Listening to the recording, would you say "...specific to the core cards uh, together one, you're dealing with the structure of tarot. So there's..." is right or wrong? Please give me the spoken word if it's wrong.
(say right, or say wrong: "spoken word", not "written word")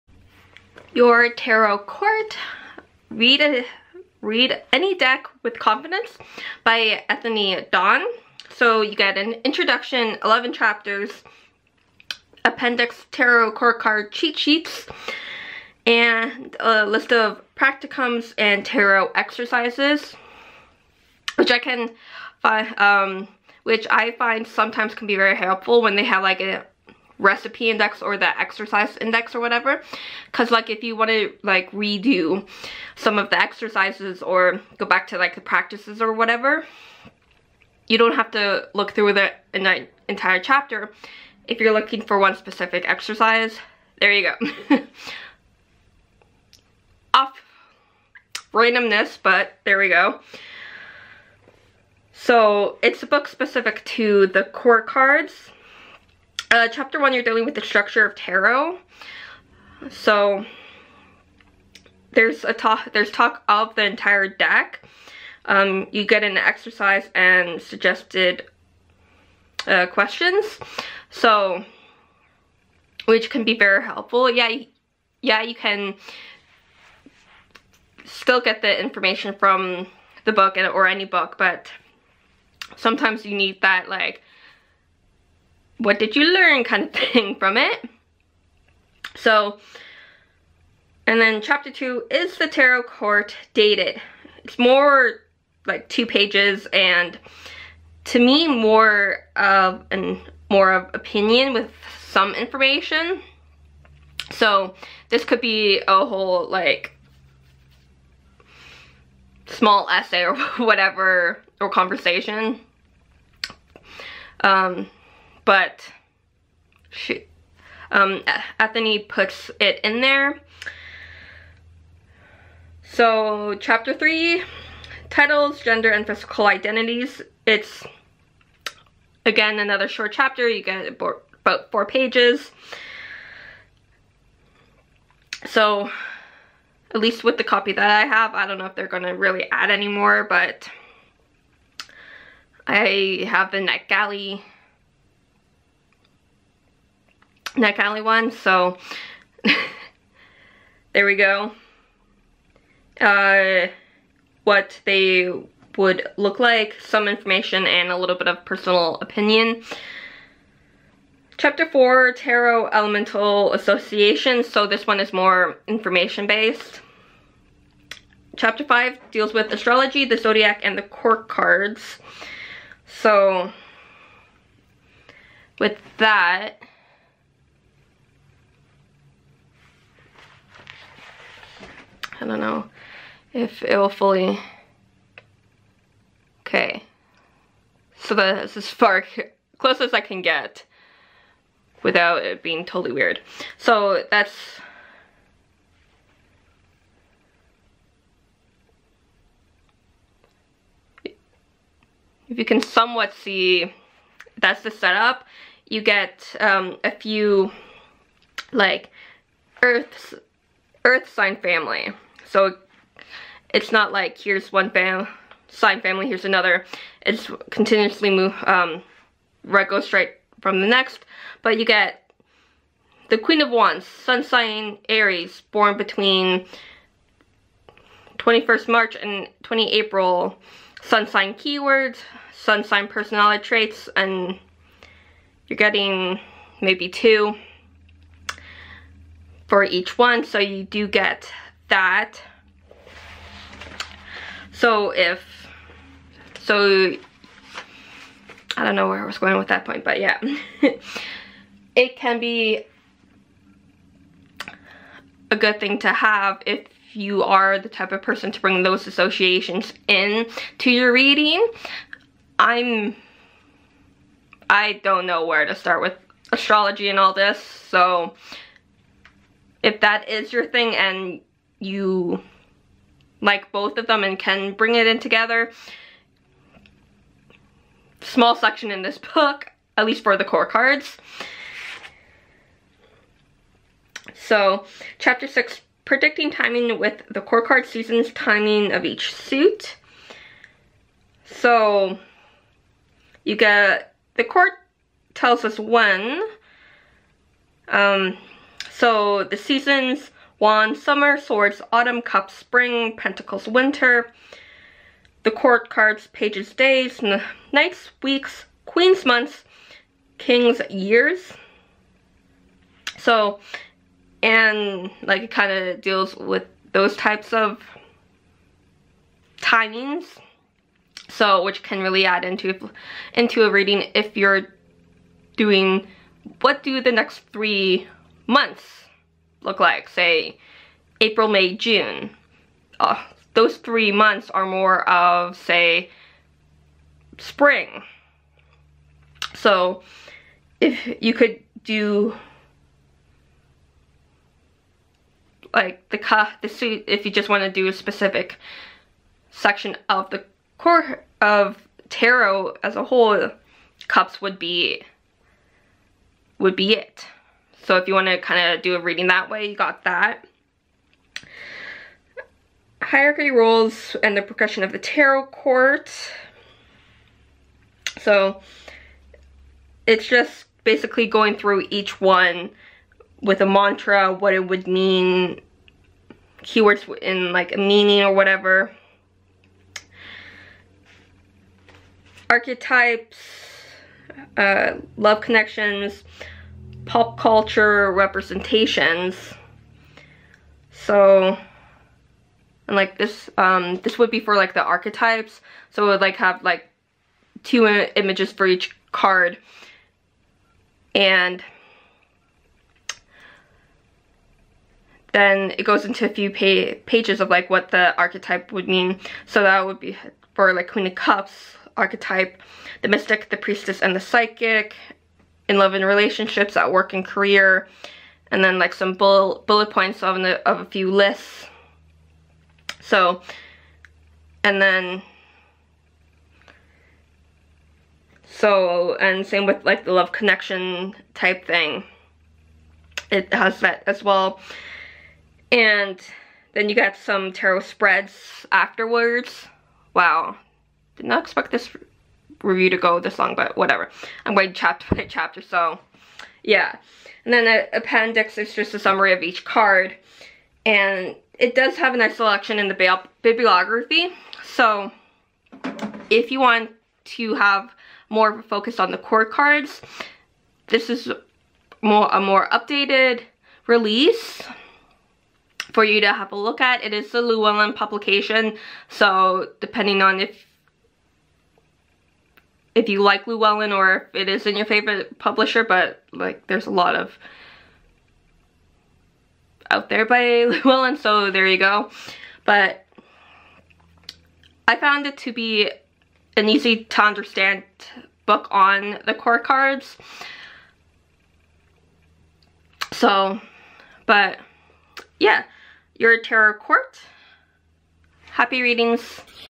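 wrong: "chapter", not "together".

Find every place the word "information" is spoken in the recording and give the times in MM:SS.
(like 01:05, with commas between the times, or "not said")
01:18, 01:42, 02:37, 02:45.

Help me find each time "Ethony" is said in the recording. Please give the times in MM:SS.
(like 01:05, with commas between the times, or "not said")
00:07, 01:58.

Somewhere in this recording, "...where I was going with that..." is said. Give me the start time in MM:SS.
04:08.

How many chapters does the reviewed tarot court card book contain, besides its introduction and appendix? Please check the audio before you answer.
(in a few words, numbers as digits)
11.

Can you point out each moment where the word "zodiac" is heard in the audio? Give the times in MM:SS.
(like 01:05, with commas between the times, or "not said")
02:50.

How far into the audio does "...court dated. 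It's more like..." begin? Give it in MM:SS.
01:32.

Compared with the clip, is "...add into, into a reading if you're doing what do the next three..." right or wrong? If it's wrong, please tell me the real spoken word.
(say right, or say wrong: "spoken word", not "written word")
right.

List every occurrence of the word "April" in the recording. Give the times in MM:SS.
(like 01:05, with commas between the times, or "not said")
03:49, 05:31.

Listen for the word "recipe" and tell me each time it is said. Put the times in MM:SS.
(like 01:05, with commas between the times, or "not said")
00:27.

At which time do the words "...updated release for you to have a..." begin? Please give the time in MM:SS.
07:42.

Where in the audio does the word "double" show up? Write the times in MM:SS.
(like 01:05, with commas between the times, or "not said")
not said.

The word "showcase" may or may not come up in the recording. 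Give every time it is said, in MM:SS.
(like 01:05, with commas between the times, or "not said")
not said.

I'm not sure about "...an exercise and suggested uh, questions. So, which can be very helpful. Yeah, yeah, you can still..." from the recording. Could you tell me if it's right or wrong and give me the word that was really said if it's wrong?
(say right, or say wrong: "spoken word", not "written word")
right.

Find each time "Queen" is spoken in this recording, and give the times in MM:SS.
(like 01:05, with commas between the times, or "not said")
03:43, 05:08, 06:50.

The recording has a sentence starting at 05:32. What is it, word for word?
Uh, those three months are more of, say, spring.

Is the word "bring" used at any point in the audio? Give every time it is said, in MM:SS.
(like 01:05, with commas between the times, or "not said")
04:18, 04:34.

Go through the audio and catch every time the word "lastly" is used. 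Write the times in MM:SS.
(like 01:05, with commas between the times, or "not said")
not said.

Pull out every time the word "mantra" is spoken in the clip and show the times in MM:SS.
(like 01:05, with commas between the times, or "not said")
06:13.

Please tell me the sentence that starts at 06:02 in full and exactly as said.
Hierarchy rules and the progression of the tarot court.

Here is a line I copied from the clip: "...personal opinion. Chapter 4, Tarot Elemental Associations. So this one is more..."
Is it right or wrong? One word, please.
right.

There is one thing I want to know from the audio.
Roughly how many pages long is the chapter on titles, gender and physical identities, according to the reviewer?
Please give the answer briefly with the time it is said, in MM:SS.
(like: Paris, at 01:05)
4, at 02:10.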